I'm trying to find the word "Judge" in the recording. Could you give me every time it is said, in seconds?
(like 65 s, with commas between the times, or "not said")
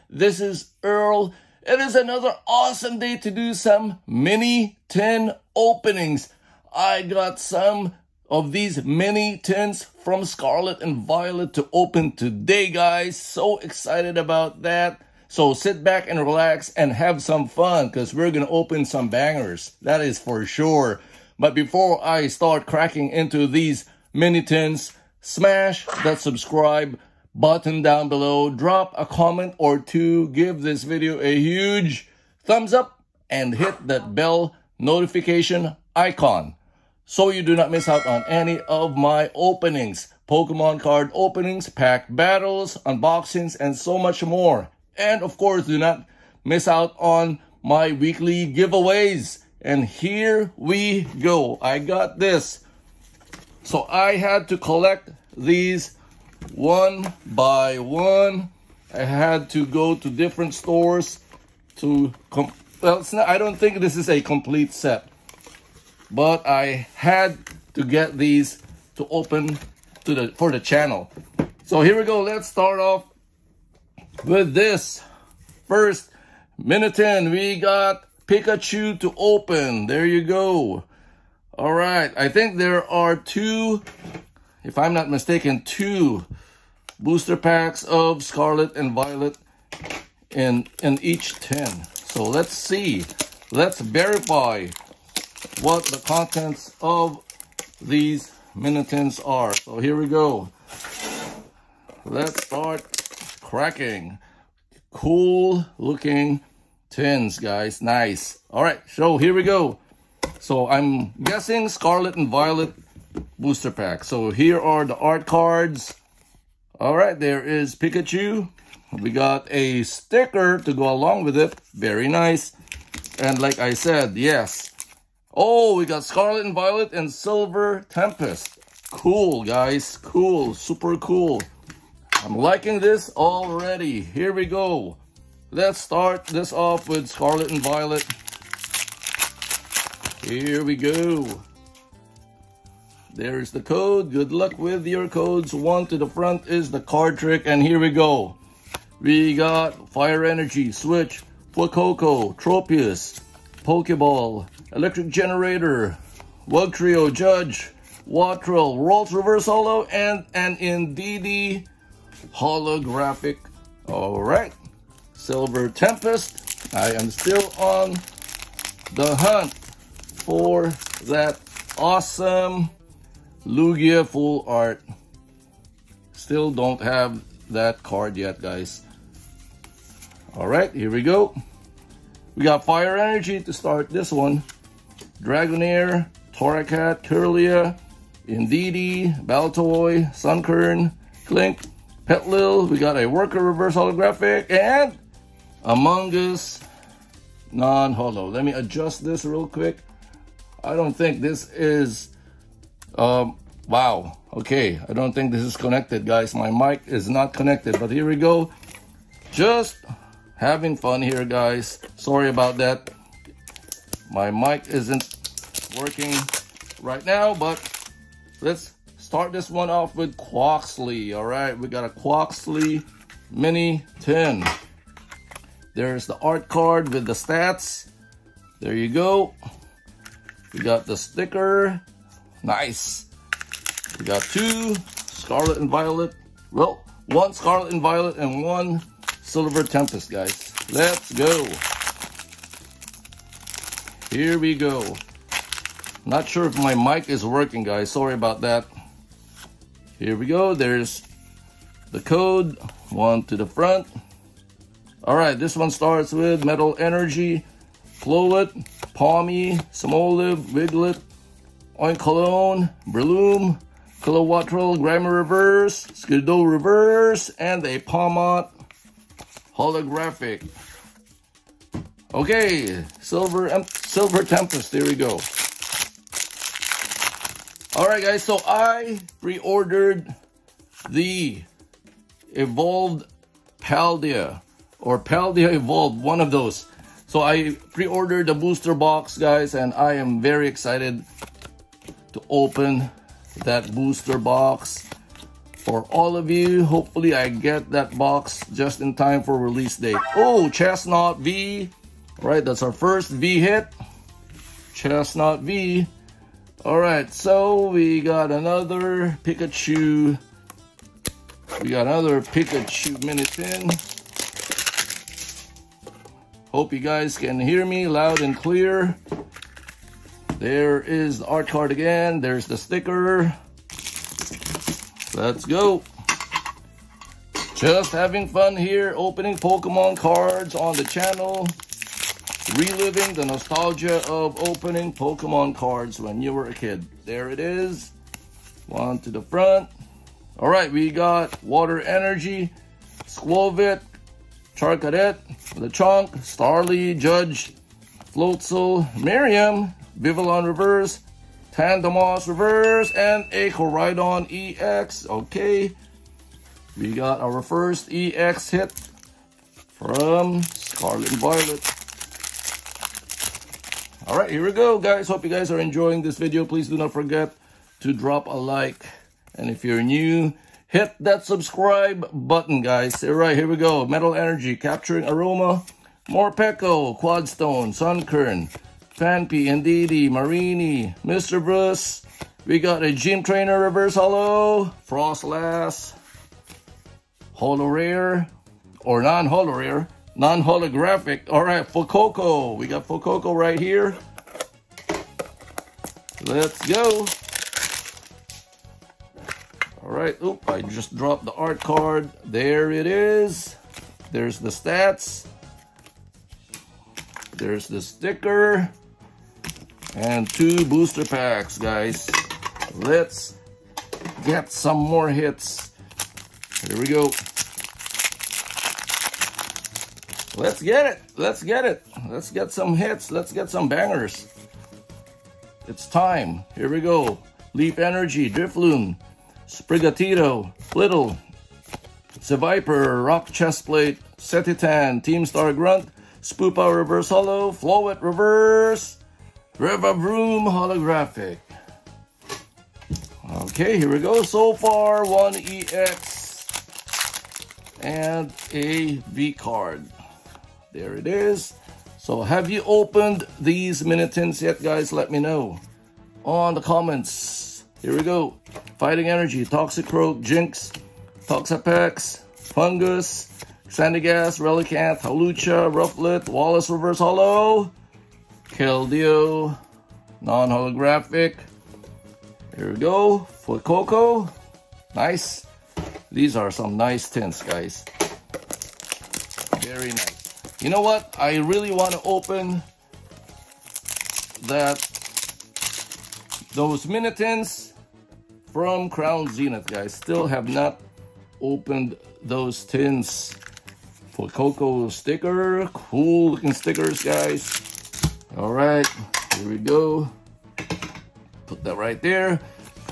157 s, 346 s.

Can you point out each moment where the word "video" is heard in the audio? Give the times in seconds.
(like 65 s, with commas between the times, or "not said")
30 s, 366 s.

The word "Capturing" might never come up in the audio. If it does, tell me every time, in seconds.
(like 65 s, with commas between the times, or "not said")
374 s.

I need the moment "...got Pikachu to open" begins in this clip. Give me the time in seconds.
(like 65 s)
77 s.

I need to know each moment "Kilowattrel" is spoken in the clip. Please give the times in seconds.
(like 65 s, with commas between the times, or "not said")
264 s.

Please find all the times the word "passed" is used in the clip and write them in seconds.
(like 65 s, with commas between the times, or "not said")
not said.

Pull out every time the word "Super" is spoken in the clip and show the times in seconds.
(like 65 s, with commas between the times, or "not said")
130 s.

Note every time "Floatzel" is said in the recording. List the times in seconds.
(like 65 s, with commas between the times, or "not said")
348 s.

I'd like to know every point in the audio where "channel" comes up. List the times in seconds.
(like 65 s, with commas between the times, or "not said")
70 s, 330 s.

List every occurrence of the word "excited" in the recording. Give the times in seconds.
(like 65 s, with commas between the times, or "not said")
13 s, 290 s.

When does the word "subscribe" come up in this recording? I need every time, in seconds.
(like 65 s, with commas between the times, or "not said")
26 s, 371 s.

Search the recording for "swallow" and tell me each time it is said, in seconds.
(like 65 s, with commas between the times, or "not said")
not said.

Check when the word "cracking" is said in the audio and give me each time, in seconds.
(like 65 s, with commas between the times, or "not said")
22 s, 103 s.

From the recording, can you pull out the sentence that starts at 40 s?
Pokemon card openings, pack battles, unboxings, and so much more.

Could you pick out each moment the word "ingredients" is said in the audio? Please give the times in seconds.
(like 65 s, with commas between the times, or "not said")
not said.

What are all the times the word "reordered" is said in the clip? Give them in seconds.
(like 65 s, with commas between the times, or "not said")
279 s.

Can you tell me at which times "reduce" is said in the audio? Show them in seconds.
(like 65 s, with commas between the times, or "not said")
not said.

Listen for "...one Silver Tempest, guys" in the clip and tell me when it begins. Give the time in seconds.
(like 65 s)
238 s.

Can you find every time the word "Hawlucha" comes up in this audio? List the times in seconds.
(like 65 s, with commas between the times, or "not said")
465 s.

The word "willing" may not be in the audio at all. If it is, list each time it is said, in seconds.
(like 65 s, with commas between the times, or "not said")
not said.